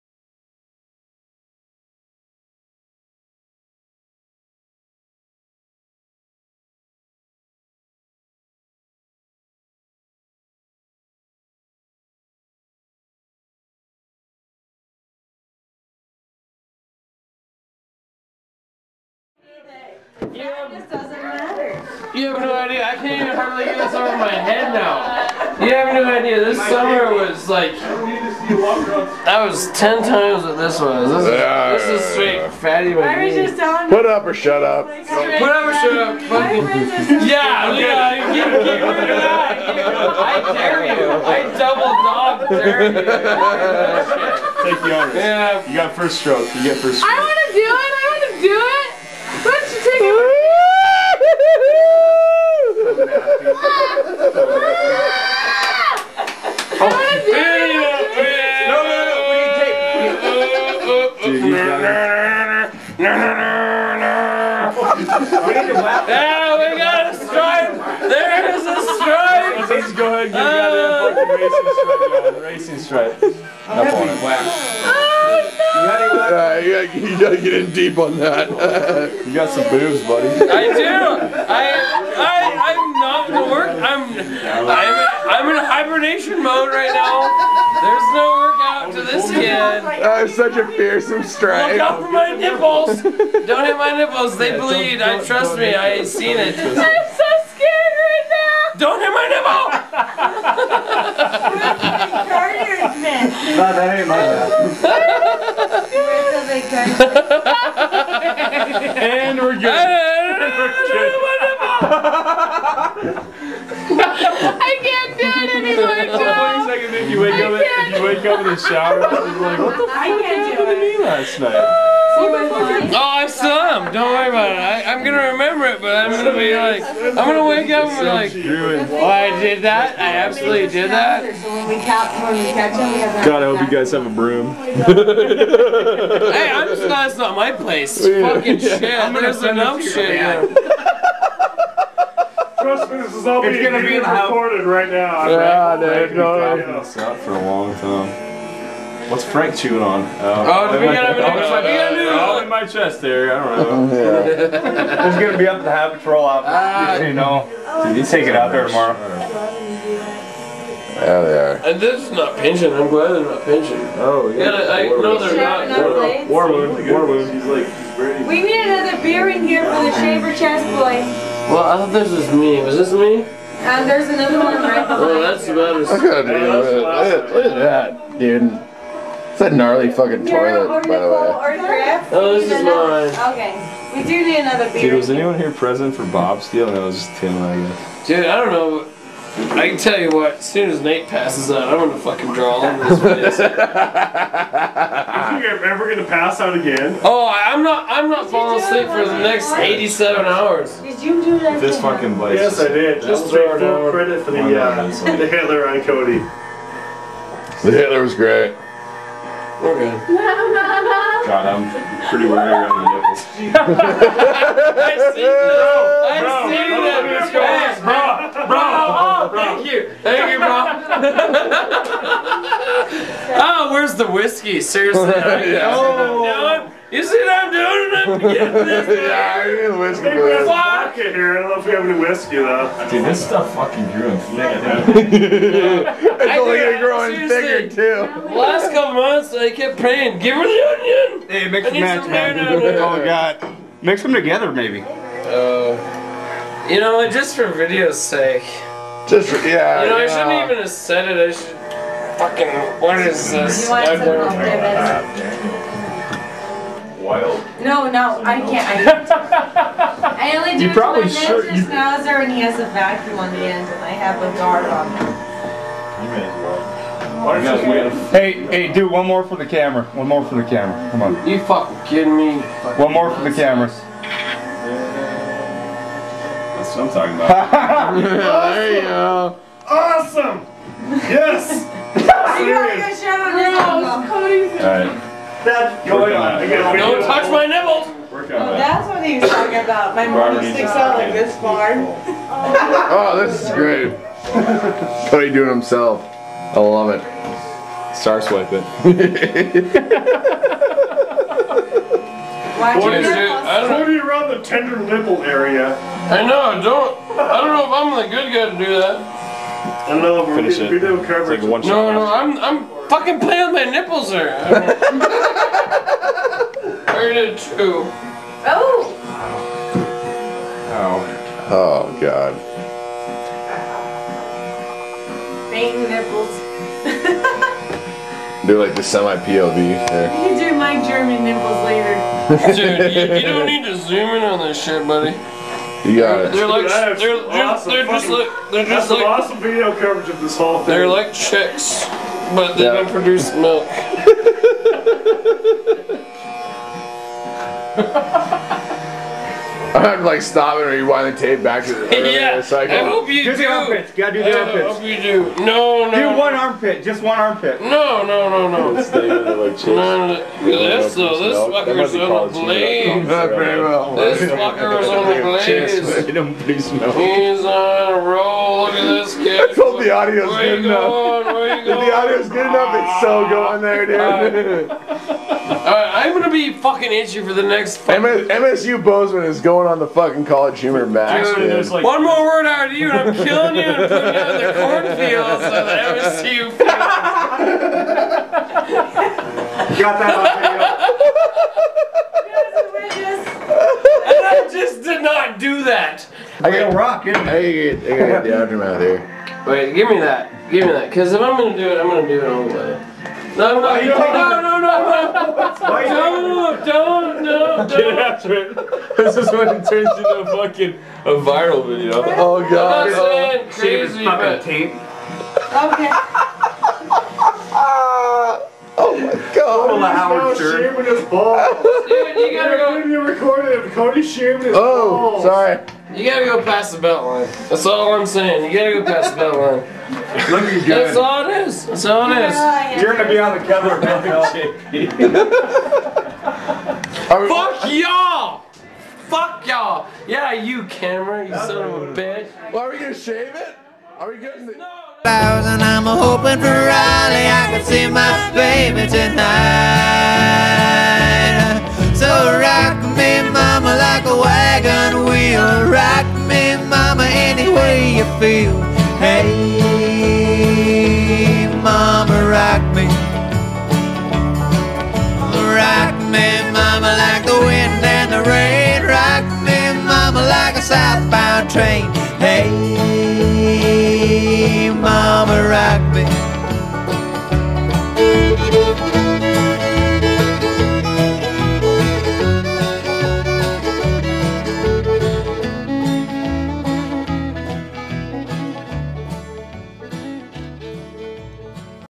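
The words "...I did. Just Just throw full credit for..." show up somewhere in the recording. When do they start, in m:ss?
3:22.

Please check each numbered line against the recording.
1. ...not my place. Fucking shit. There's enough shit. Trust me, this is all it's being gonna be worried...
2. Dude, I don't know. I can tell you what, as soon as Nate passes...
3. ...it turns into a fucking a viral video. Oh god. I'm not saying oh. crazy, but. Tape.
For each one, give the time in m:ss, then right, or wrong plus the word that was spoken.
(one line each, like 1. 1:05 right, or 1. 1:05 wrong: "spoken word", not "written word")
1. 2:17 wrong: "recorded", not "worried"
2. 3:08 right
3. 6:49 right.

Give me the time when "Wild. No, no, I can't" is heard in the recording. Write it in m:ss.
4:17.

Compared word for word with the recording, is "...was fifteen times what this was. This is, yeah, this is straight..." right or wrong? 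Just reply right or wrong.
wrong.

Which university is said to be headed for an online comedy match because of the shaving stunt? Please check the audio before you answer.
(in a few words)
MSU Bozeman.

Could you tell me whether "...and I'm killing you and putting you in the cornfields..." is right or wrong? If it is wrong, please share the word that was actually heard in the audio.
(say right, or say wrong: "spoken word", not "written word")
right.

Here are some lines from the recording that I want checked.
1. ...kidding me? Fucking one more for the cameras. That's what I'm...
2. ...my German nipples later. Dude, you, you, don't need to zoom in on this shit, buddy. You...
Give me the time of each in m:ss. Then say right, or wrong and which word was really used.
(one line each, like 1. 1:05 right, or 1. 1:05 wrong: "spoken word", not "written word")
1. 4:31 right
2. 5:30 right.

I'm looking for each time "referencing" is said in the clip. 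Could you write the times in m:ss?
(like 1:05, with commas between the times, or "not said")
not said.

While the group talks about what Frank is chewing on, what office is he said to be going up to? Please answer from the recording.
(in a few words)
Habit Patrol office.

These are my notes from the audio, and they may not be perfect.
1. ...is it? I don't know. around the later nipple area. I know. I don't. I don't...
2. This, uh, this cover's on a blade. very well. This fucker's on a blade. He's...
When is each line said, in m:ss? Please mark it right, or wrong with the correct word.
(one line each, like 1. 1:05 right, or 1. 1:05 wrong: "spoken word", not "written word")
1. 5:02 wrong: "tender", not "later"
2. 6:00 wrong: "fucker", not "cover".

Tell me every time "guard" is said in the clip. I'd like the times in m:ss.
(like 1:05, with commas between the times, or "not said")
4:24.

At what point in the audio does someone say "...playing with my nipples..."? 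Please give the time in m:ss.
5:13.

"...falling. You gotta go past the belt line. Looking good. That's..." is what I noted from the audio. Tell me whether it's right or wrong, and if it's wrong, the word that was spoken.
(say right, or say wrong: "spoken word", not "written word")
wrong: "saying", not "falling".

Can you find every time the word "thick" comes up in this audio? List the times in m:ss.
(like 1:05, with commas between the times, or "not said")
3:54.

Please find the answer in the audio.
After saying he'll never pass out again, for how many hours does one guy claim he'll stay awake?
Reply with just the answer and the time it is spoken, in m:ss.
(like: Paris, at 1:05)
87, at 3:19.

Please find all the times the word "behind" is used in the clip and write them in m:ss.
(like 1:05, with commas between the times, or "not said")
2:54.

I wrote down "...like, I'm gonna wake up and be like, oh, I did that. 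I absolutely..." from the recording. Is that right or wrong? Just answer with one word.
right.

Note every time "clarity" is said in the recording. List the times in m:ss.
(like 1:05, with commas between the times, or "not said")
not said.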